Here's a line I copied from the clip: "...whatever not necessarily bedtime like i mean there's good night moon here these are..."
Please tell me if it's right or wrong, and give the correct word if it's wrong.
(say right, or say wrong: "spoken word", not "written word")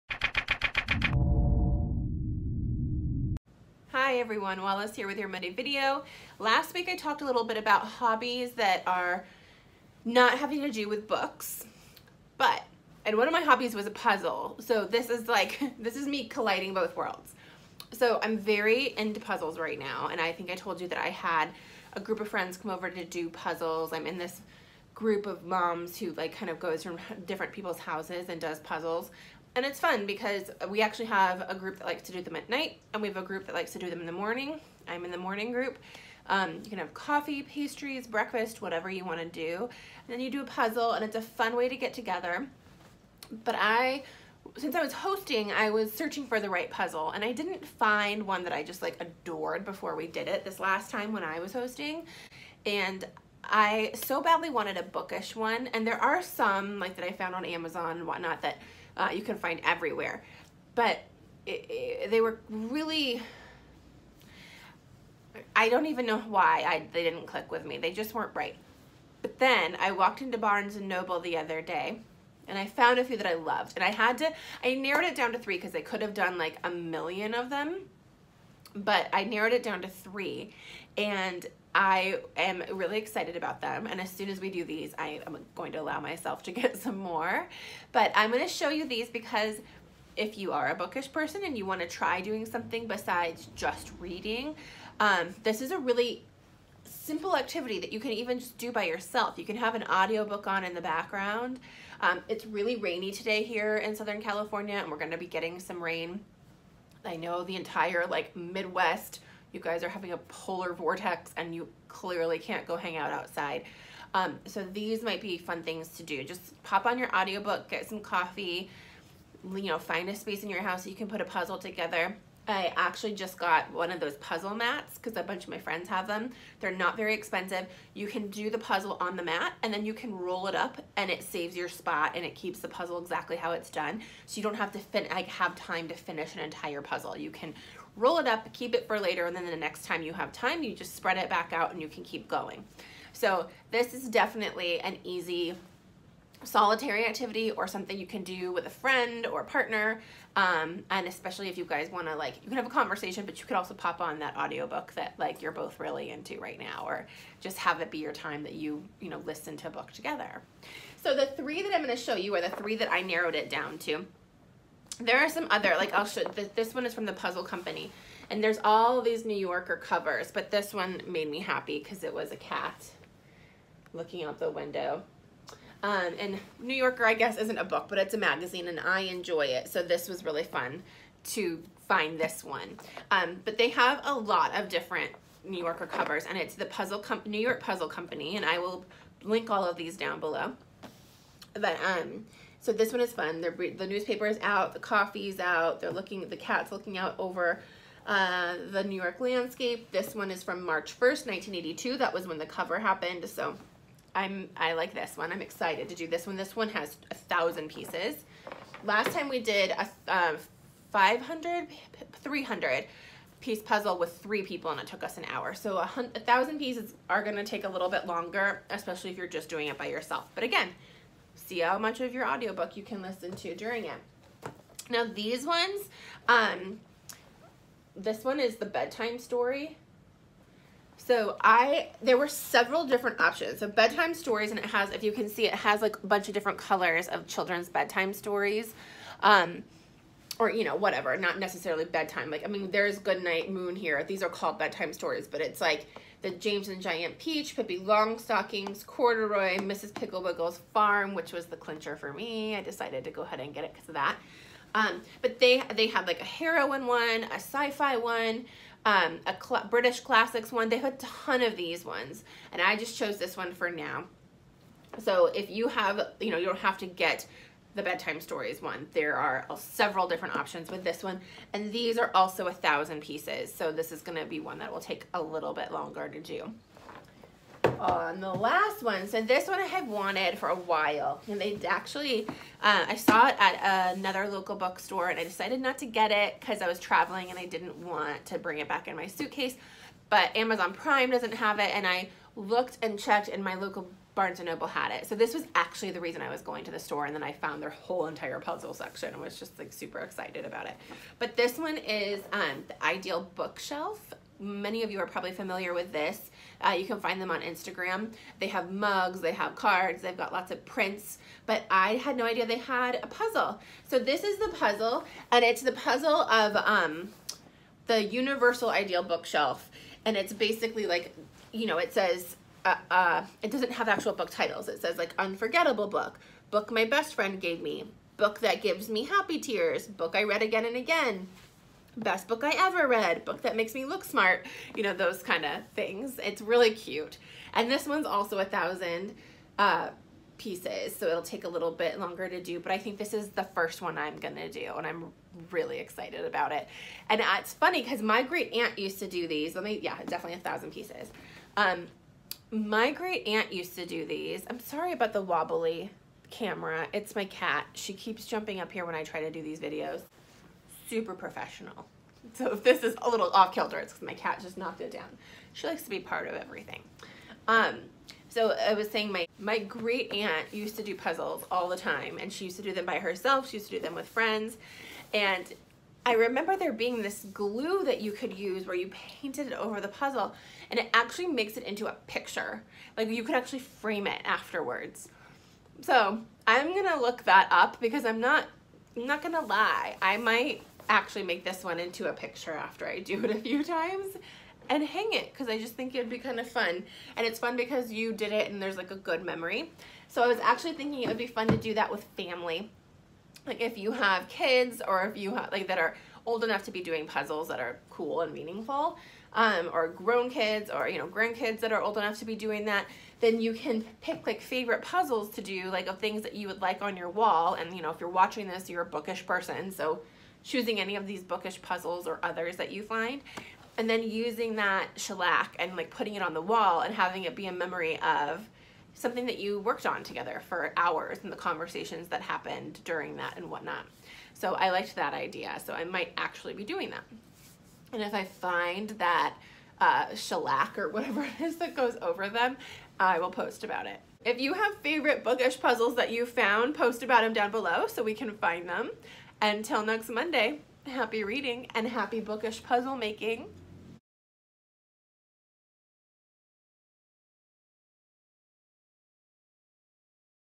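right.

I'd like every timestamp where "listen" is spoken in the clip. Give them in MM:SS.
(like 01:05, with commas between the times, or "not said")
02:39, 03:43.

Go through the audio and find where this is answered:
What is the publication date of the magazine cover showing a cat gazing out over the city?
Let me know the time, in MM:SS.
03:20.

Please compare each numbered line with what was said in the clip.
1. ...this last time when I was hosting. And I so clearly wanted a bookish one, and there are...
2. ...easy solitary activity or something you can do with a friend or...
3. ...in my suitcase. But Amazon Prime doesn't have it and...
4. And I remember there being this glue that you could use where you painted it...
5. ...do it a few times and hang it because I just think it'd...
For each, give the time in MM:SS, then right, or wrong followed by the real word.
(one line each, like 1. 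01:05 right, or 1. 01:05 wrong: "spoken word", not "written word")
1. 00:50 wrong: "badly", not "clearly"
2. 02:25 right
3. 04:48 right
4. 06:15 right
5. 06:32 right.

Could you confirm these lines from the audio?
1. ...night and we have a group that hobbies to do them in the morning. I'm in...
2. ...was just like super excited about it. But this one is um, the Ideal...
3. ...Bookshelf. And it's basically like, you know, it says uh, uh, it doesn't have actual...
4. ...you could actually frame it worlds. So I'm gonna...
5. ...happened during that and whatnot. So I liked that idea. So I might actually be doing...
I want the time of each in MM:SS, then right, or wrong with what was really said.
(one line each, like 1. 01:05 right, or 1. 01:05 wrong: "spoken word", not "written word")
1. 00:32 wrong: "likes", not "hobbies"
2. 04:59 right
3. 05:19 right
4. 06:23 wrong: "afterwards", not "worlds"
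5. 07:12 right.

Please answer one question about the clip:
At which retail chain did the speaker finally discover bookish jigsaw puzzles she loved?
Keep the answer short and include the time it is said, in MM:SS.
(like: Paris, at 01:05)
Barnes and Noble, at 01:10.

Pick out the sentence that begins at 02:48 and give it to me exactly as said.
And there's all these New Yorker covers, but this one made me happy because it was a cat looking out the window.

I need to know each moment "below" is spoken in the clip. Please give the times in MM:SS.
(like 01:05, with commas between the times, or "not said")
03:10, 07:27.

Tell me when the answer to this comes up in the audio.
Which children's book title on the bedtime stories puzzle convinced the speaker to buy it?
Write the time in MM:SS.
04:09.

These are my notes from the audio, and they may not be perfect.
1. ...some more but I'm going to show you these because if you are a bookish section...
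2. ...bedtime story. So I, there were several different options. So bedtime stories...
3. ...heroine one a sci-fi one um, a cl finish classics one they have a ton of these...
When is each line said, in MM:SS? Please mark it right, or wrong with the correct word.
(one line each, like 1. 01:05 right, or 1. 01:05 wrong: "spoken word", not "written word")
1. 01:26 wrong: "person", not "section"
2. 03:48 right
3. 04:16 wrong: "british", not "finish".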